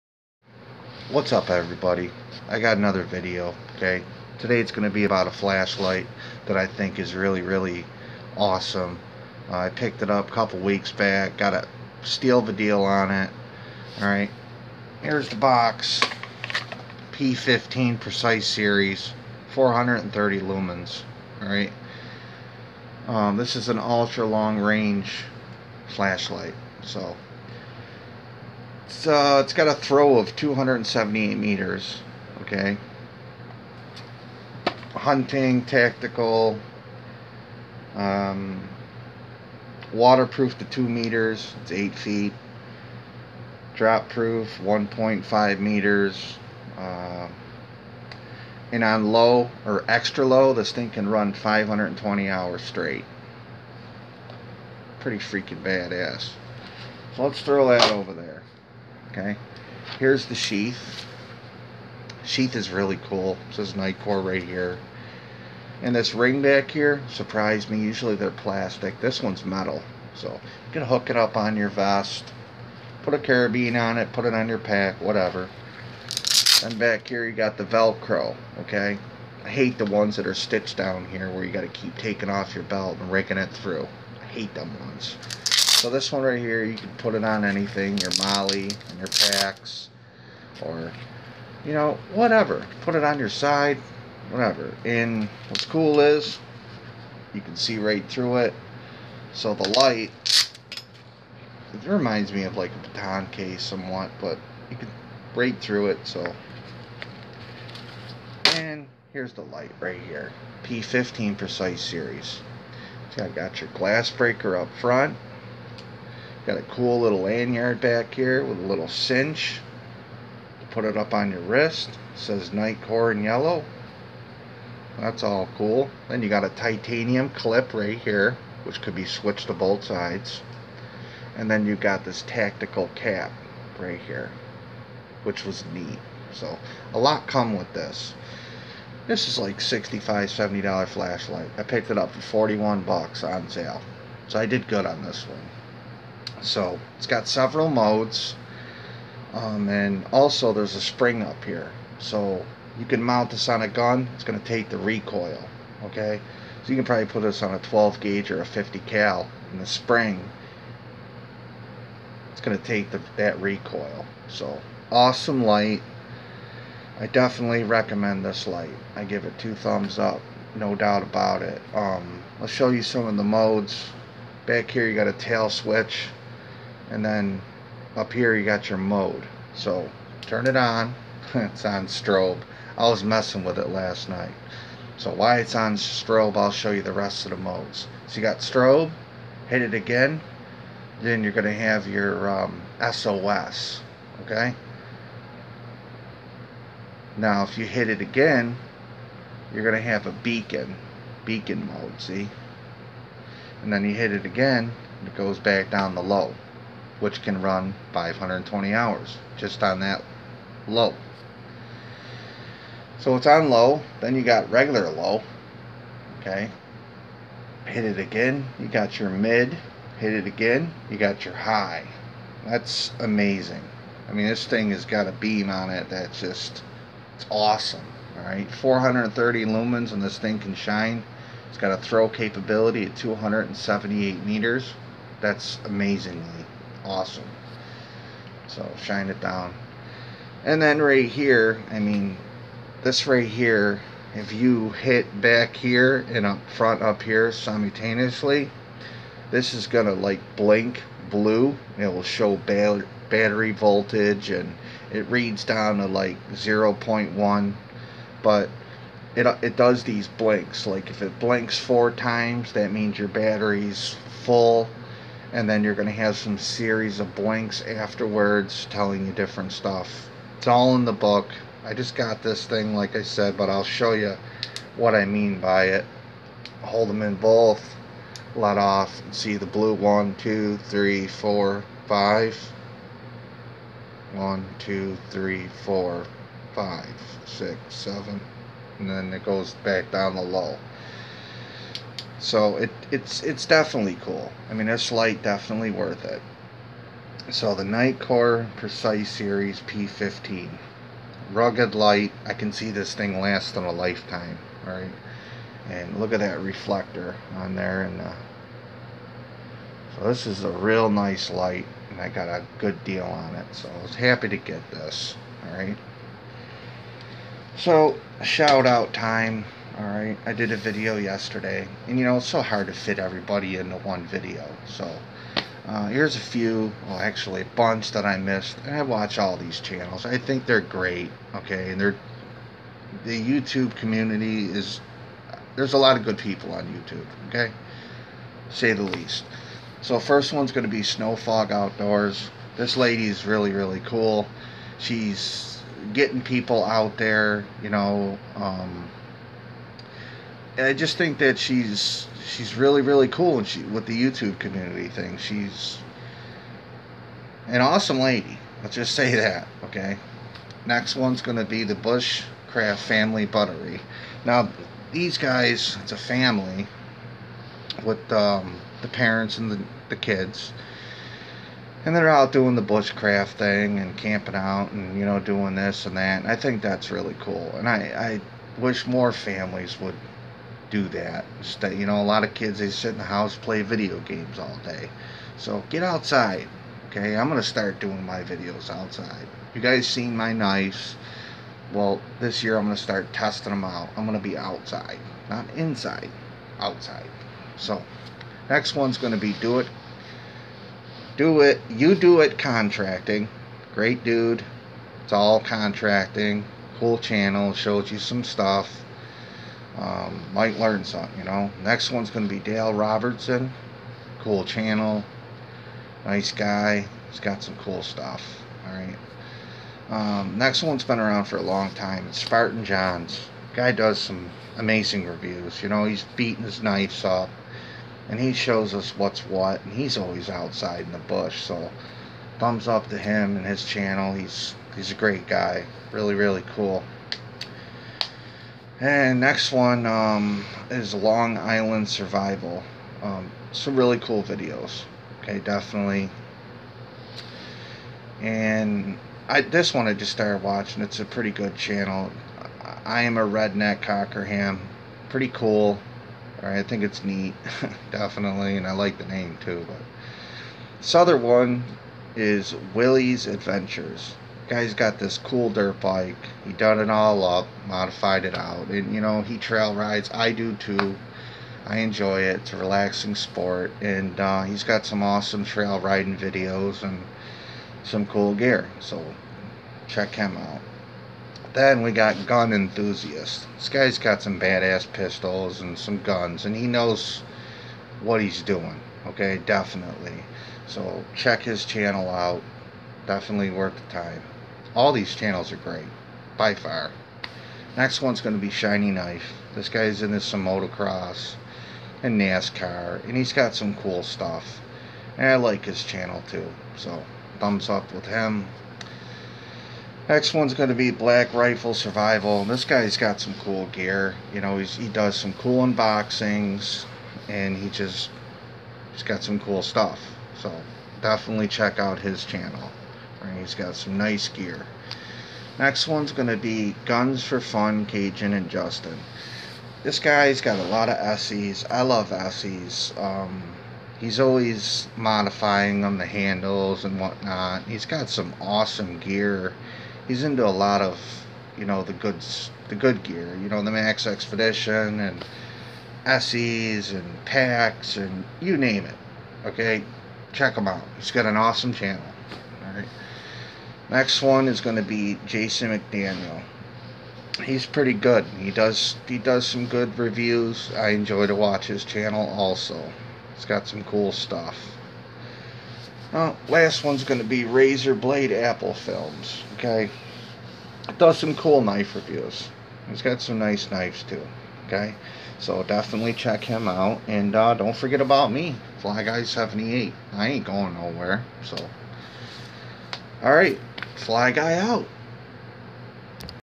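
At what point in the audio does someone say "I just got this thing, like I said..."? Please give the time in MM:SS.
04:31.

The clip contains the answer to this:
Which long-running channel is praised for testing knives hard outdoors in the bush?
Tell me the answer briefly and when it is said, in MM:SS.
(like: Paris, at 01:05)
Spartan Johns, at 07:02.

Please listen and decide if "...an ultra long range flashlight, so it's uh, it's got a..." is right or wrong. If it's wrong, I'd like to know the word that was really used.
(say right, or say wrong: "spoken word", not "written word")
right.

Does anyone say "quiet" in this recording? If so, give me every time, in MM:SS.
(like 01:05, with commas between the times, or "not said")
not said.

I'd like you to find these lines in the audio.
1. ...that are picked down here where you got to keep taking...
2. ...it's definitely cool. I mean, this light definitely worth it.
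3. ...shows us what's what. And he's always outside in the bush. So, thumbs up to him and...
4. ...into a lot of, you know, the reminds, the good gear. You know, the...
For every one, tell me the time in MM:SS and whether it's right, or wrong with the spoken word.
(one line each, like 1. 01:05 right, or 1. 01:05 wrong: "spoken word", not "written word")
1. 01:20 wrong: "stitched", not "picked"
2. 04:53 right
3. 07:08 right
4. 09:00 wrong: "goods", not "reminds".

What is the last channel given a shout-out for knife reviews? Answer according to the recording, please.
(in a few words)
Razor Blade Apple Films.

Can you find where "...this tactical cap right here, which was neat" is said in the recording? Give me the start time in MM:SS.
02:12.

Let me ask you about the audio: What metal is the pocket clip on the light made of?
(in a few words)
Titanium.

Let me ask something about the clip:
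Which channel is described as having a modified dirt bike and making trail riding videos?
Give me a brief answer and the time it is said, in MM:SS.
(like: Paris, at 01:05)
Willie's Adventures, at 07:42.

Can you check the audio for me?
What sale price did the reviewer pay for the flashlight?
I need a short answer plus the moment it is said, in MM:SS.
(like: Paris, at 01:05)
$41, at 02:22.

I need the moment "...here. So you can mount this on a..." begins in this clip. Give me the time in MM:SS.
02:31.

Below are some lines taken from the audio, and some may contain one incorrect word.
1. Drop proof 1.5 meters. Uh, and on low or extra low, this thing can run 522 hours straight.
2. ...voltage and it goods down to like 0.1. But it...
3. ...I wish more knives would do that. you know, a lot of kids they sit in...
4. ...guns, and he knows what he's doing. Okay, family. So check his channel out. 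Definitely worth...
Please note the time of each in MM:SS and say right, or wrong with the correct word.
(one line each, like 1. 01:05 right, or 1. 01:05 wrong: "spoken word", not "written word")
1. 00:43 wrong: "520", not "522"
2. 04:13 wrong: "reads", not "goods"
3. 06:18 wrong: "families", not "knives"
4. 08:06 wrong: "definitely", not "family".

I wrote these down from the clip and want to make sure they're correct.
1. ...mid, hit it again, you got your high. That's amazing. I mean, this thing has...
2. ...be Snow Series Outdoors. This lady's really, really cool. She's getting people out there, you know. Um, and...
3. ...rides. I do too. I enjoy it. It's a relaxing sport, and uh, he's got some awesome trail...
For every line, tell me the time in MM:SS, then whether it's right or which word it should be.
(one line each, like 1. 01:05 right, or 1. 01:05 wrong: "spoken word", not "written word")
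1. 03:39 right
2. 05:40 wrong: "Fog", not "Series"
3. 07:49 right.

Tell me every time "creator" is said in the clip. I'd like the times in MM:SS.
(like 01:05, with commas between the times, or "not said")
not said.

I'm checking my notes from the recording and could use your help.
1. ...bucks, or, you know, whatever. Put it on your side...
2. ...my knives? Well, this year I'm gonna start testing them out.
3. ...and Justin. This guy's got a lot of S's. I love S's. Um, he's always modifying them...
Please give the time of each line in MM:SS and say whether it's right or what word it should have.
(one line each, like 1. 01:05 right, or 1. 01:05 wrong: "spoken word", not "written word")
1. 01:29 wrong: "packs", not "bucks"
2. 06:30 right
3. 08:48 right.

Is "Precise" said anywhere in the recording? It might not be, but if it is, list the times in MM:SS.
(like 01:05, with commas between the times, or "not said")
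00:17, 01:51, 04:58.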